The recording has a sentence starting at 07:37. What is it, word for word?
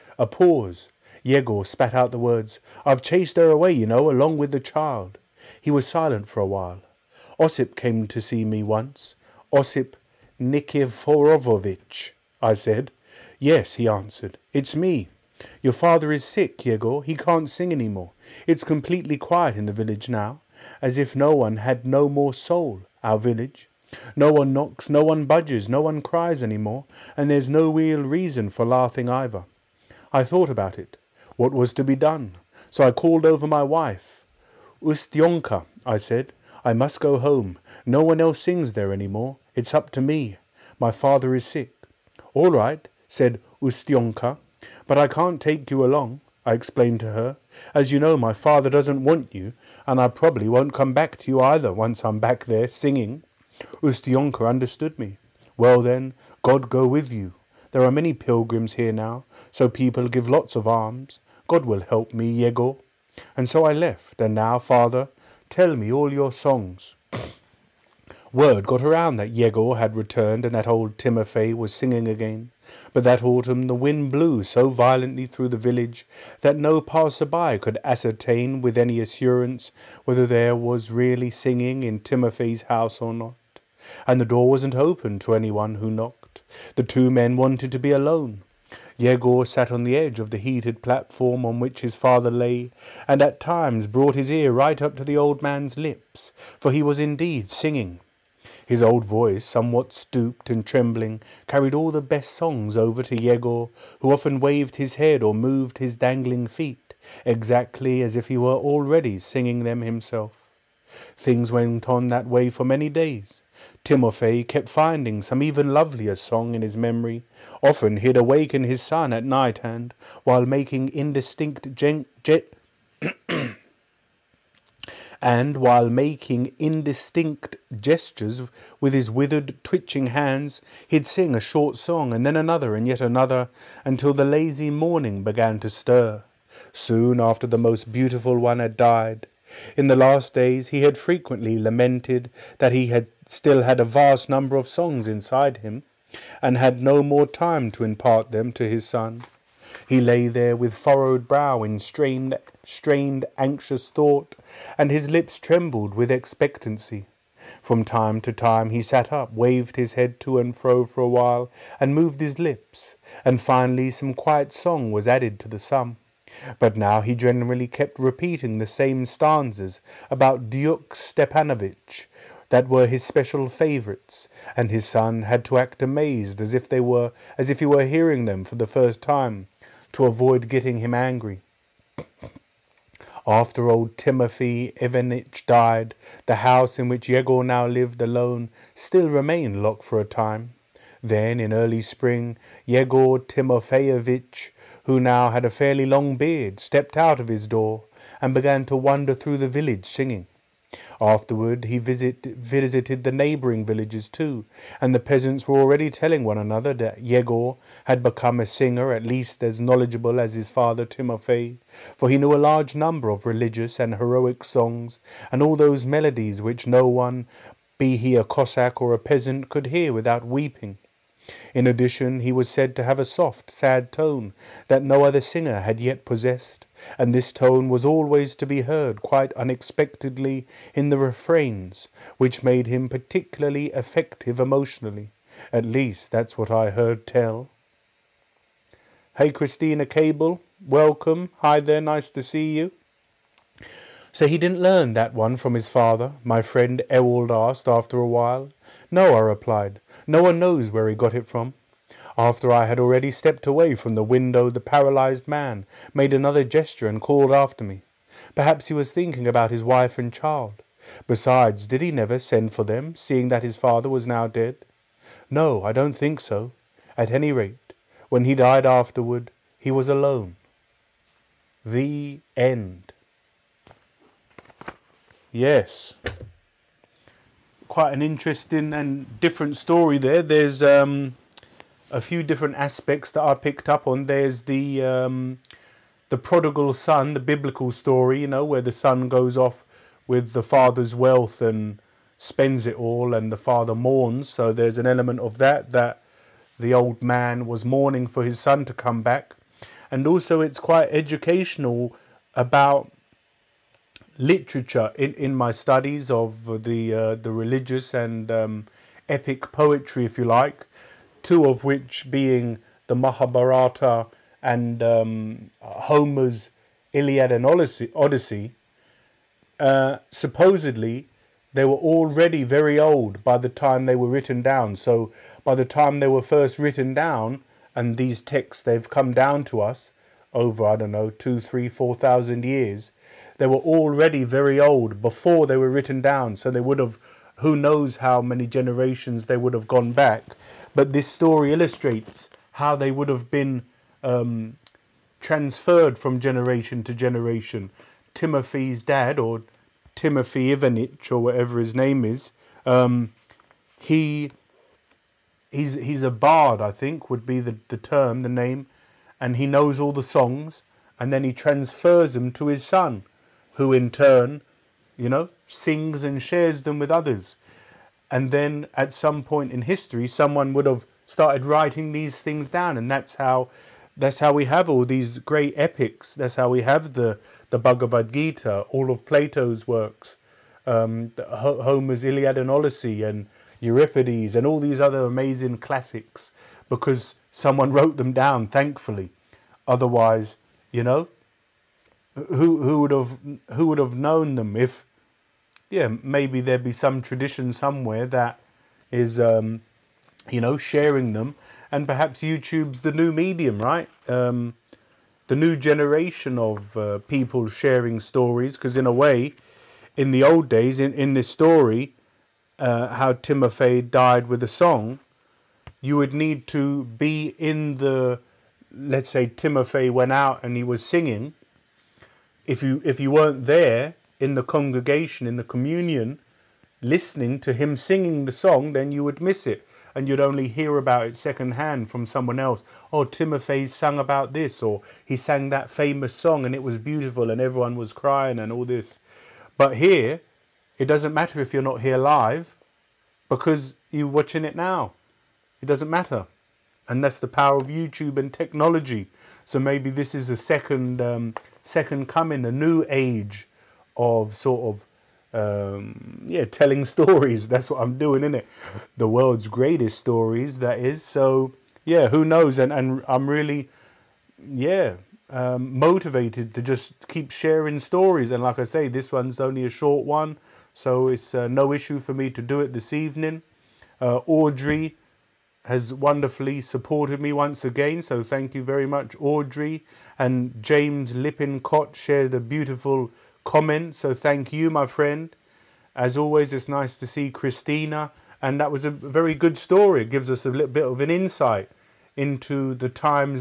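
That's what I'm doing, isn't it?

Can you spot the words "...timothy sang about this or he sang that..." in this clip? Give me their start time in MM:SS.
07:13.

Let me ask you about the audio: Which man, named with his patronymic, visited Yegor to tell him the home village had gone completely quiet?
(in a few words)
Ossip Nikiforovitch.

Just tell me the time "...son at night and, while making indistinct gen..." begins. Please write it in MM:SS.
01:58.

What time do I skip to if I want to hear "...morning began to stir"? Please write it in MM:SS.
02:14.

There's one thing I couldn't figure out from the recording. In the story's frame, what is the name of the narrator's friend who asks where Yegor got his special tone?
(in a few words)
Ewald.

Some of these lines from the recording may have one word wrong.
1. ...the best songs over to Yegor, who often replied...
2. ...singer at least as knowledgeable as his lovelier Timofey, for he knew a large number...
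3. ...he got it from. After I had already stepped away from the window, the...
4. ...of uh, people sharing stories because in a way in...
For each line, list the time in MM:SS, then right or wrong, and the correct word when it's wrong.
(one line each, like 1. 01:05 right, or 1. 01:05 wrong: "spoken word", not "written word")
1. 01:41 wrong: "waved", not "replied"
2. 03:28 wrong: "father", not "lovelier"
3. 04:10 right
4. 06:46 right.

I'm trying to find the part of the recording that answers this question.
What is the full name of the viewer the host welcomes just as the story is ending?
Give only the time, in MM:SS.
03:59.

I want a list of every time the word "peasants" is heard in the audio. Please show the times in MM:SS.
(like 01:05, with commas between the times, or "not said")
03:24, 03:38.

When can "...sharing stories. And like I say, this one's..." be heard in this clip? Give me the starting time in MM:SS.
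07:47.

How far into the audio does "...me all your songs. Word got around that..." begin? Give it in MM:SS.
01:05.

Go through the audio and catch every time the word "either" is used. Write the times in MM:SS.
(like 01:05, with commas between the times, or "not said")
00:29, 00:51.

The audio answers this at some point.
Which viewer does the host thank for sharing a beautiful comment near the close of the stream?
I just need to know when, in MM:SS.
08:00.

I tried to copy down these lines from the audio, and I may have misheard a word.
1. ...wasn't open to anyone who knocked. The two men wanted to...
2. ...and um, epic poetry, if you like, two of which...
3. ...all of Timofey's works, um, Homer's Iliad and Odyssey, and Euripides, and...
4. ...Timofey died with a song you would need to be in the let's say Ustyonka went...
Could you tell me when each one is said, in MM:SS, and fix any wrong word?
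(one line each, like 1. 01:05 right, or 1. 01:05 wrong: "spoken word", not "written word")
1. 01:24 right
2. 05:07 right
3. 06:18 wrong: "Plato", not "Timofey"
4. 06:53 wrong: "Timofey", not "Ustyonka".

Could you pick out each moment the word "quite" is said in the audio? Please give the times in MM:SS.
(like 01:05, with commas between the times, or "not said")
03:49, 04:37, 05:00.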